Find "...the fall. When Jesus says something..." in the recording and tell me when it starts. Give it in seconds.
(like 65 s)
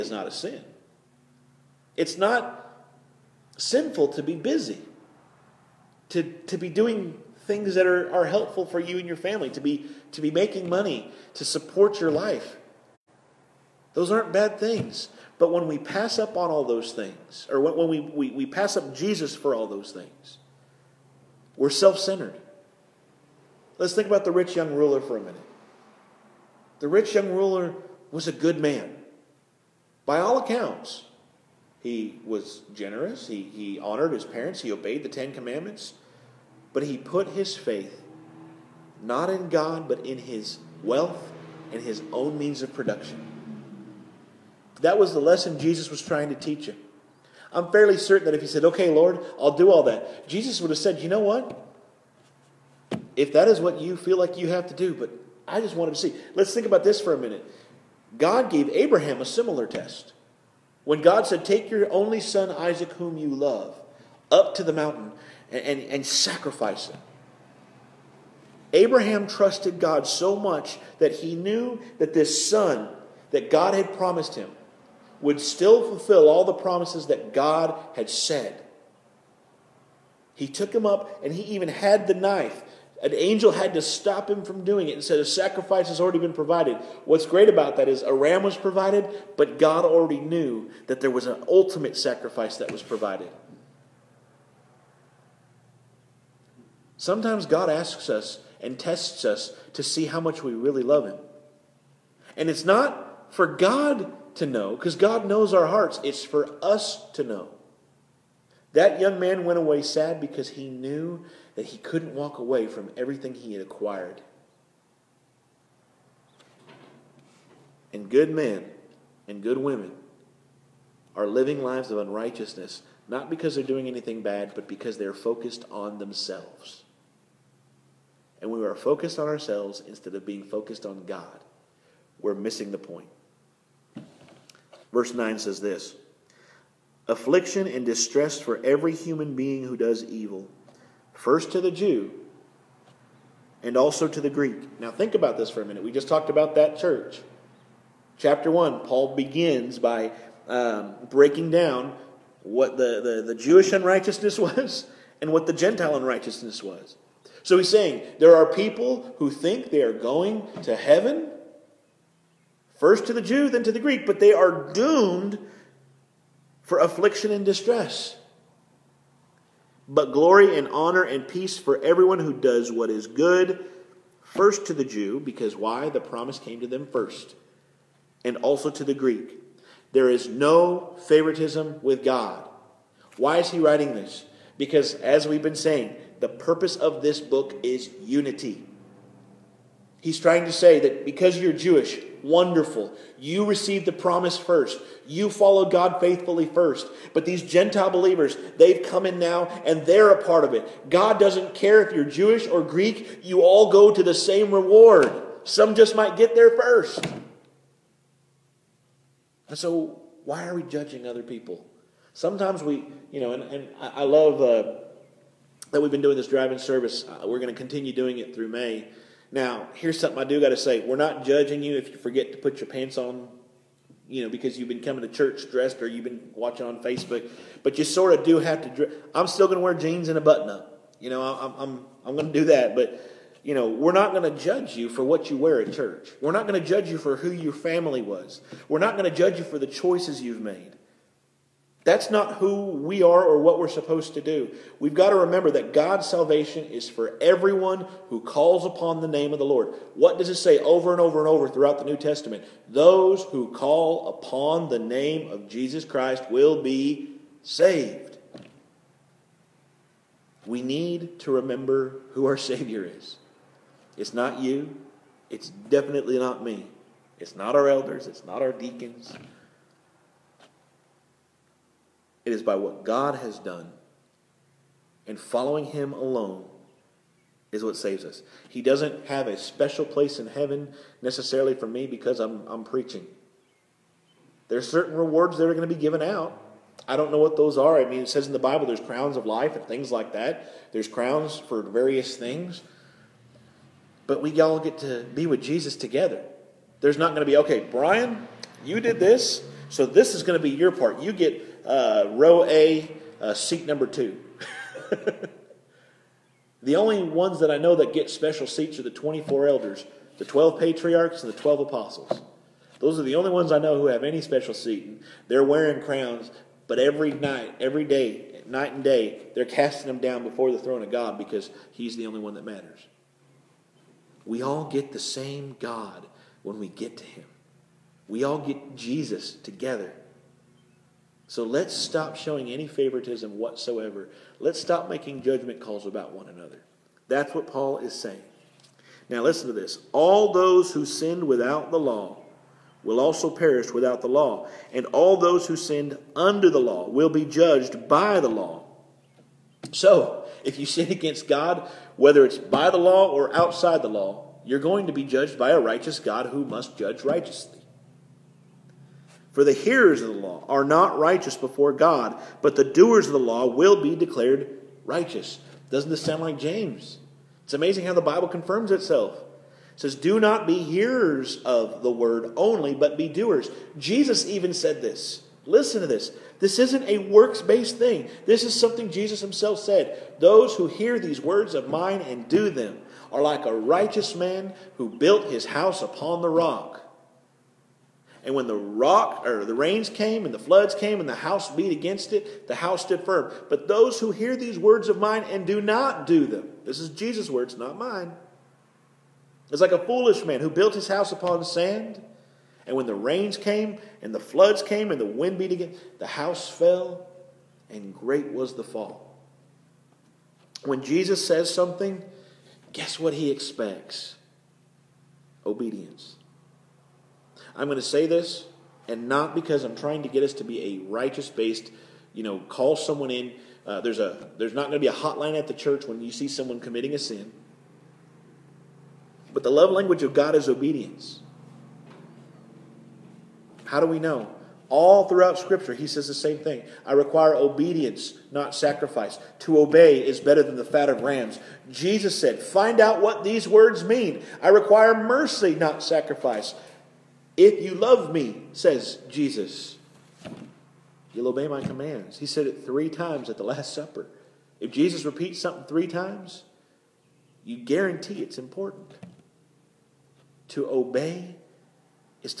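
408 s.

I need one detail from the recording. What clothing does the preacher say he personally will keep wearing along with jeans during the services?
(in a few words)
A button-up.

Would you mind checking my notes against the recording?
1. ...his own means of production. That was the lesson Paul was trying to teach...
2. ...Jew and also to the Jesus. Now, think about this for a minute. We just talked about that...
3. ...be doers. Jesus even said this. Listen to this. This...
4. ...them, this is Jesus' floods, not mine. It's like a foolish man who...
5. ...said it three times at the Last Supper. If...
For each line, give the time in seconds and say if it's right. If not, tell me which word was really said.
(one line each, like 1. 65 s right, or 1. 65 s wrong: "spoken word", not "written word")
1. 41 s wrong: "Jesus", not "Paul"
2. 141 s wrong: "Greek", not "Jesus"
3. 372 s right
4. 396 s wrong: "words", not "floods"
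5. 452 s right.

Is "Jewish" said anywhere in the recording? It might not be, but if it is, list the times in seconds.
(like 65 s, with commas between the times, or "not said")
153 s, 191 s, 202 s.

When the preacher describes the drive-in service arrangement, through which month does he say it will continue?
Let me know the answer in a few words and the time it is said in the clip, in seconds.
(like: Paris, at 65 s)
May, at 218 s.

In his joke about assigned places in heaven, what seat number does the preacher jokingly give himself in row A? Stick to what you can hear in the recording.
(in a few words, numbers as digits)
2.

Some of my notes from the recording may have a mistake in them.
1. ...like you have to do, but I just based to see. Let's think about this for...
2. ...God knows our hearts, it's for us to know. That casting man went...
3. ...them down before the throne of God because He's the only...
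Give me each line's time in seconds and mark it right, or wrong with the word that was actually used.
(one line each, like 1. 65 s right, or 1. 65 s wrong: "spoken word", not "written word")
1. 54 s wrong: "wanted", not "based"
2. 104 s wrong: "young", not "casting"
3. 319 s right.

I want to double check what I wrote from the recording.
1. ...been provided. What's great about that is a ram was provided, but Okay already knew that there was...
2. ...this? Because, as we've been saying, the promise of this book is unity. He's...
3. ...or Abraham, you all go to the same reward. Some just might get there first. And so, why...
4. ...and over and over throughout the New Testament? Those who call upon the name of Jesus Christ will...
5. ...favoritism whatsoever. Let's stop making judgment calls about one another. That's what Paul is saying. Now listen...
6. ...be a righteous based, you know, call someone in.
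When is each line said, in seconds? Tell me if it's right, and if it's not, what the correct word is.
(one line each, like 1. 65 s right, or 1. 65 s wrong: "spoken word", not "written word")
1. 86 s wrong: "God", not "Okay"
2. 183 s wrong: "purpose", not "promise"
3. 202 s wrong: "Greek", not "Abraham"
4. 250 s right
5. 332 s right
6. 420 s right.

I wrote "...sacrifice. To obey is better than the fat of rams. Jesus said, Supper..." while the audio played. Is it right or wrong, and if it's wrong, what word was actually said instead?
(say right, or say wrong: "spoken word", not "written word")
wrong: "Find", not "Supper".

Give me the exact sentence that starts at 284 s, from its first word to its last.
There's certain rewards that are going to be given out.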